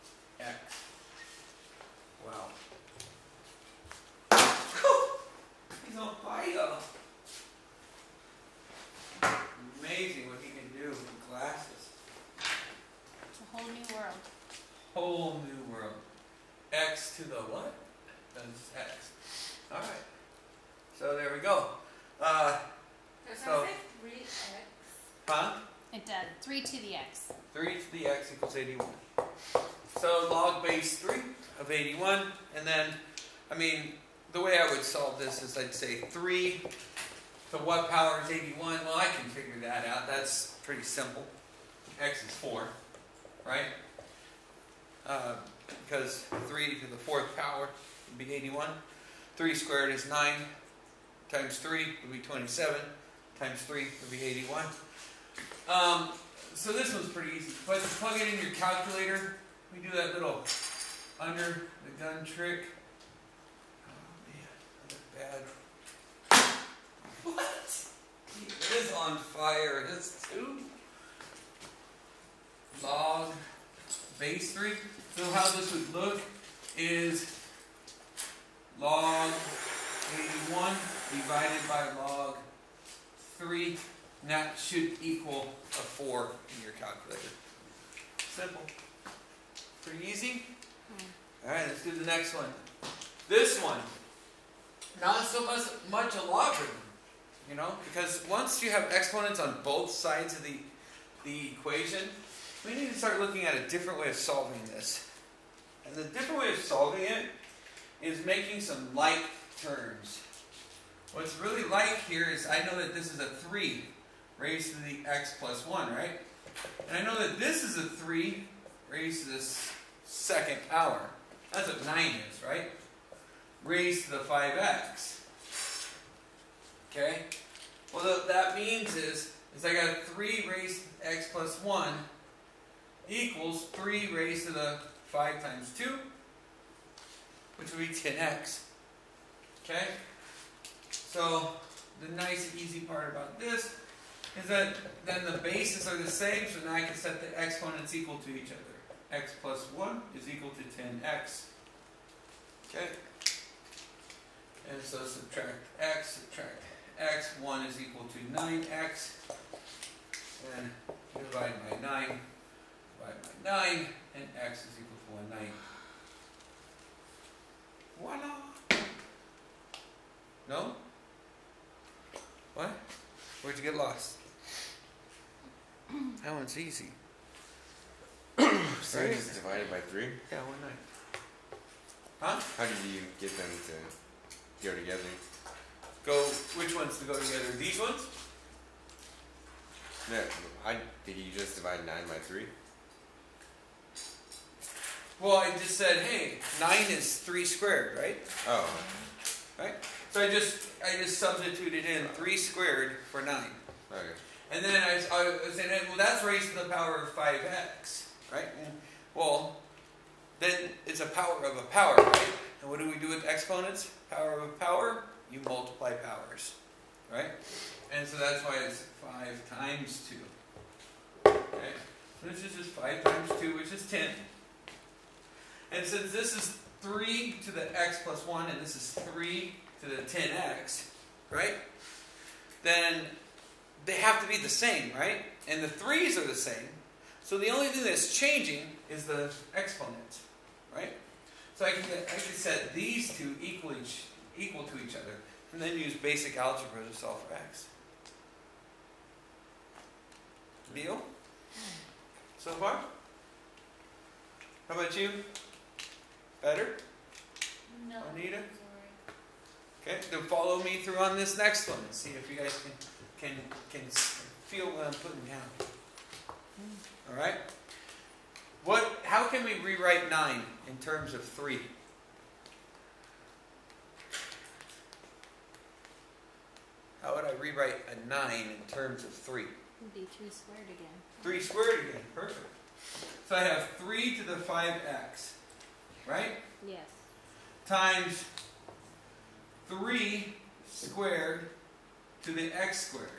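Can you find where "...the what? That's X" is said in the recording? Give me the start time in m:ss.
0:17.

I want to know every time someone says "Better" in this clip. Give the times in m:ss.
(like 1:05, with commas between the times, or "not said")
4:16.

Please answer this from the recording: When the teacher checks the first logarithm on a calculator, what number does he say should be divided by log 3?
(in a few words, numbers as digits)
log 81.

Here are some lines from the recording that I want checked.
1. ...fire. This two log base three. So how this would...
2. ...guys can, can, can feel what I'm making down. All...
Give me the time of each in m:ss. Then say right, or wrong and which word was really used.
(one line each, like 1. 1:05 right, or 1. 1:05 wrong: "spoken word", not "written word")
1. 1:09 right
2. 4:22 wrong: "putting", not "making".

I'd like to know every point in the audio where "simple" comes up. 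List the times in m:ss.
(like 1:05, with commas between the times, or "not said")
0:40, 1:28.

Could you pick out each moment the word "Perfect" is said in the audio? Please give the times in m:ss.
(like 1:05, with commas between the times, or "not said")
4:42.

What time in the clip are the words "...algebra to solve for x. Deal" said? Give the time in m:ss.
4:06.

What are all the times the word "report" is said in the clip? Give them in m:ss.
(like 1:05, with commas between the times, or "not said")
not said.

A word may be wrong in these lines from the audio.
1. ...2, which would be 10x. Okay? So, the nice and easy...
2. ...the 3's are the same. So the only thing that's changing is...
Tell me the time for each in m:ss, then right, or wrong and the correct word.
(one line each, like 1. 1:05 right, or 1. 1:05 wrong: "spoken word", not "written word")
1. 2:15 right
2. 3:55 right.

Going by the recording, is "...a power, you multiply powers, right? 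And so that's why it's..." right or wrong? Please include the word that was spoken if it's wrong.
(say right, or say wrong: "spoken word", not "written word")
right.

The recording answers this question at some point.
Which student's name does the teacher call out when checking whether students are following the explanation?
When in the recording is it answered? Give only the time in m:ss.
4:18.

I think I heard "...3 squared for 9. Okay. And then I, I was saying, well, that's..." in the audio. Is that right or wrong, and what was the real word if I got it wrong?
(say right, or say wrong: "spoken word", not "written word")
right.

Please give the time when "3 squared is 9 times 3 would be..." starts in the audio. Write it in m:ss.
0:49.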